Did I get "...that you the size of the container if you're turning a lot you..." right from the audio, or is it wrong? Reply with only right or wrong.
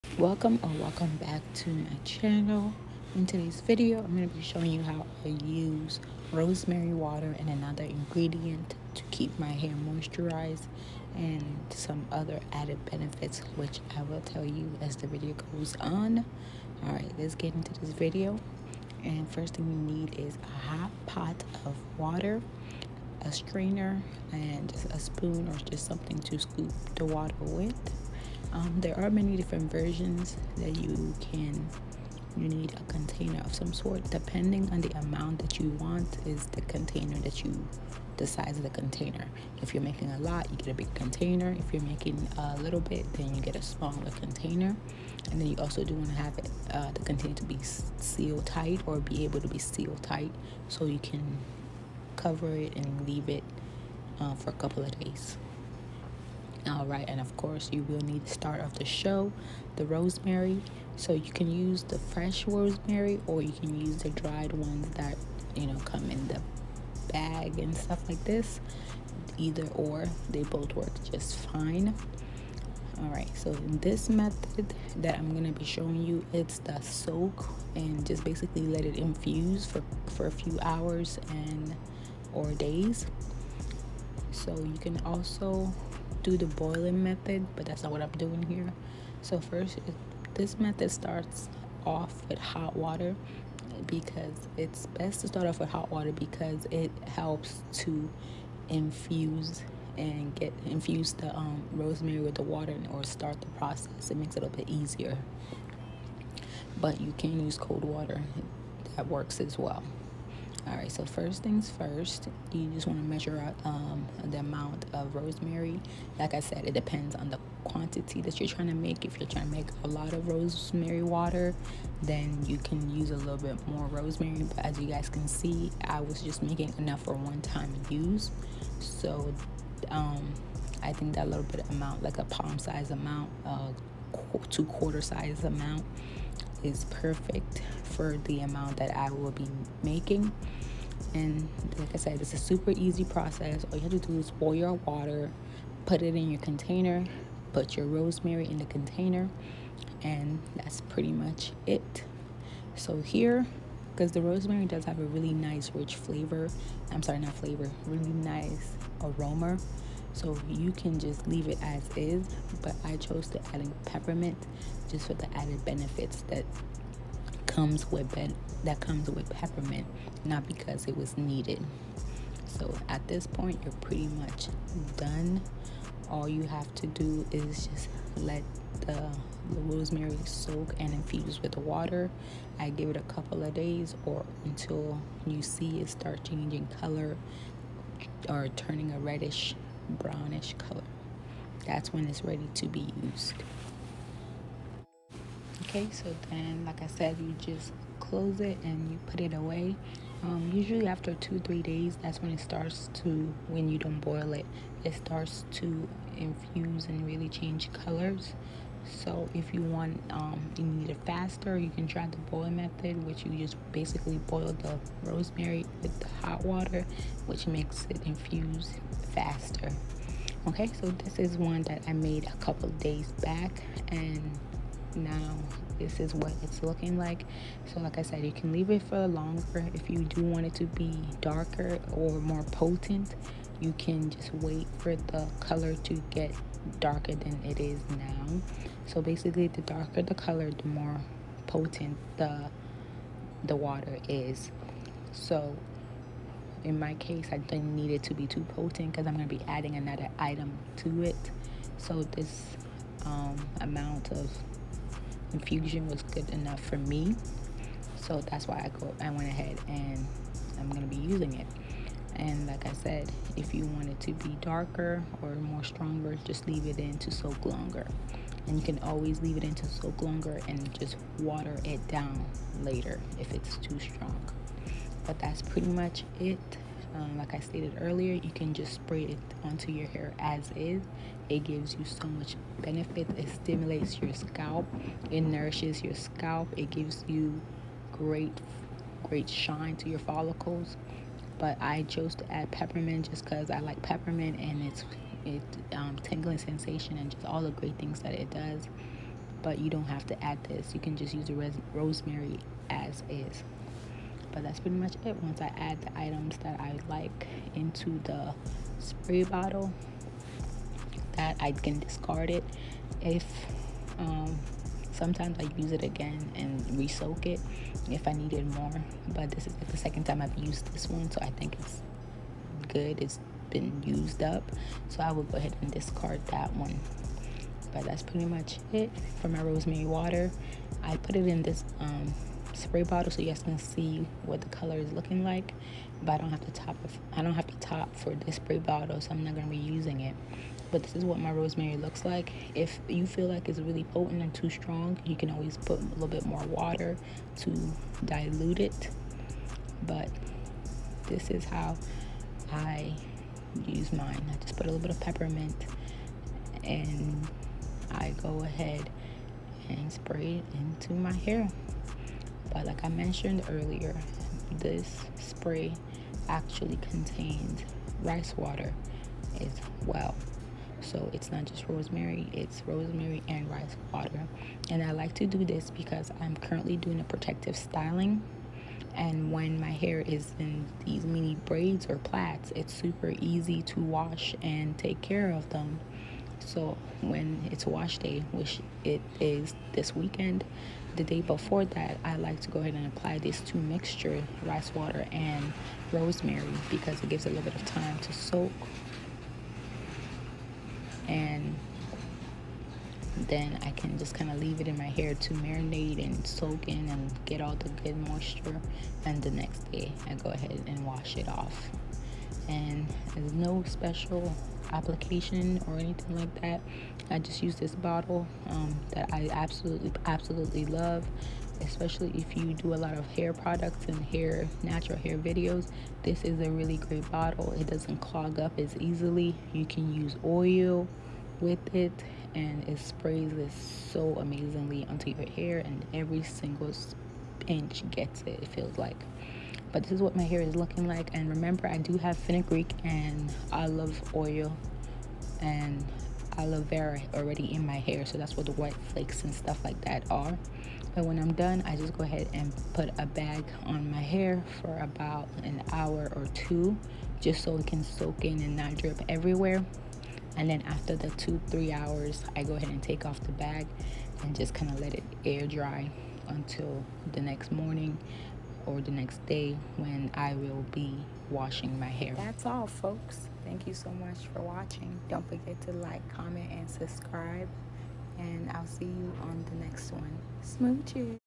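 wrong.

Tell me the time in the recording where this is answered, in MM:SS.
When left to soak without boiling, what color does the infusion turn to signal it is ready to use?
03:08.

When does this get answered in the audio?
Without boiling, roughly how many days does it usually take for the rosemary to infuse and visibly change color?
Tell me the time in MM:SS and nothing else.
03:21.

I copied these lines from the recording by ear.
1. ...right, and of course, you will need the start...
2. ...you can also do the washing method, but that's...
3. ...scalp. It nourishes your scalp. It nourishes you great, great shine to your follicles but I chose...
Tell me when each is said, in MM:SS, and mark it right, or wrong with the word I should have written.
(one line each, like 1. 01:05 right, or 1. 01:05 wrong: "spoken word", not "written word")
1. 00:56 right
2. 01:24 wrong: "boiling", not "washing"
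3. 04:44 wrong: "gives", not "nourishes".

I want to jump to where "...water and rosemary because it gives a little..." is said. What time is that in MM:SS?
06:34.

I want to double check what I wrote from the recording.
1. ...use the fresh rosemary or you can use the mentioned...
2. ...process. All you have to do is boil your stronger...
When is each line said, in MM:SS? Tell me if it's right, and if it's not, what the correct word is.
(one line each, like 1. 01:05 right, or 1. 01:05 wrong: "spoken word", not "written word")
1. 01:01 wrong: "dried", not "mentioned"
2. 02:23 wrong: "water", not "stronger".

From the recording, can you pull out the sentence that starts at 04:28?
And you can always leave it in to soak longer and just water it down later if it's too strong.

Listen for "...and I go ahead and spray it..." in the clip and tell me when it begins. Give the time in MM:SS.
05:56.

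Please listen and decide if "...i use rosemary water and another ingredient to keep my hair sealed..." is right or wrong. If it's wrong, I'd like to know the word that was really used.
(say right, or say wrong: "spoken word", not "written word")
wrong: "moisturized", not "sealed".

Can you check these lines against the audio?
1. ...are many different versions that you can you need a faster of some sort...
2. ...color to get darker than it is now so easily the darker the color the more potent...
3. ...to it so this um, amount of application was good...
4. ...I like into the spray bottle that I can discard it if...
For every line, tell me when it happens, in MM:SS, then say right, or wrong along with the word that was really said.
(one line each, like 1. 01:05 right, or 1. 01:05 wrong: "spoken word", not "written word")
1. 00:28 wrong: "container", not "faster"
2. 03:55 wrong: "basically", not "easily"
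3. 04:10 wrong: "infusion", not "application"
4. 05:06 right.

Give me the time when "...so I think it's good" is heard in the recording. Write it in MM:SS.
05:21.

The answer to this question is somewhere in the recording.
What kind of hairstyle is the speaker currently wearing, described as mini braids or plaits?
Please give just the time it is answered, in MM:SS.
06:17.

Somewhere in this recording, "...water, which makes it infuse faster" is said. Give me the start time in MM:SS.
03:36.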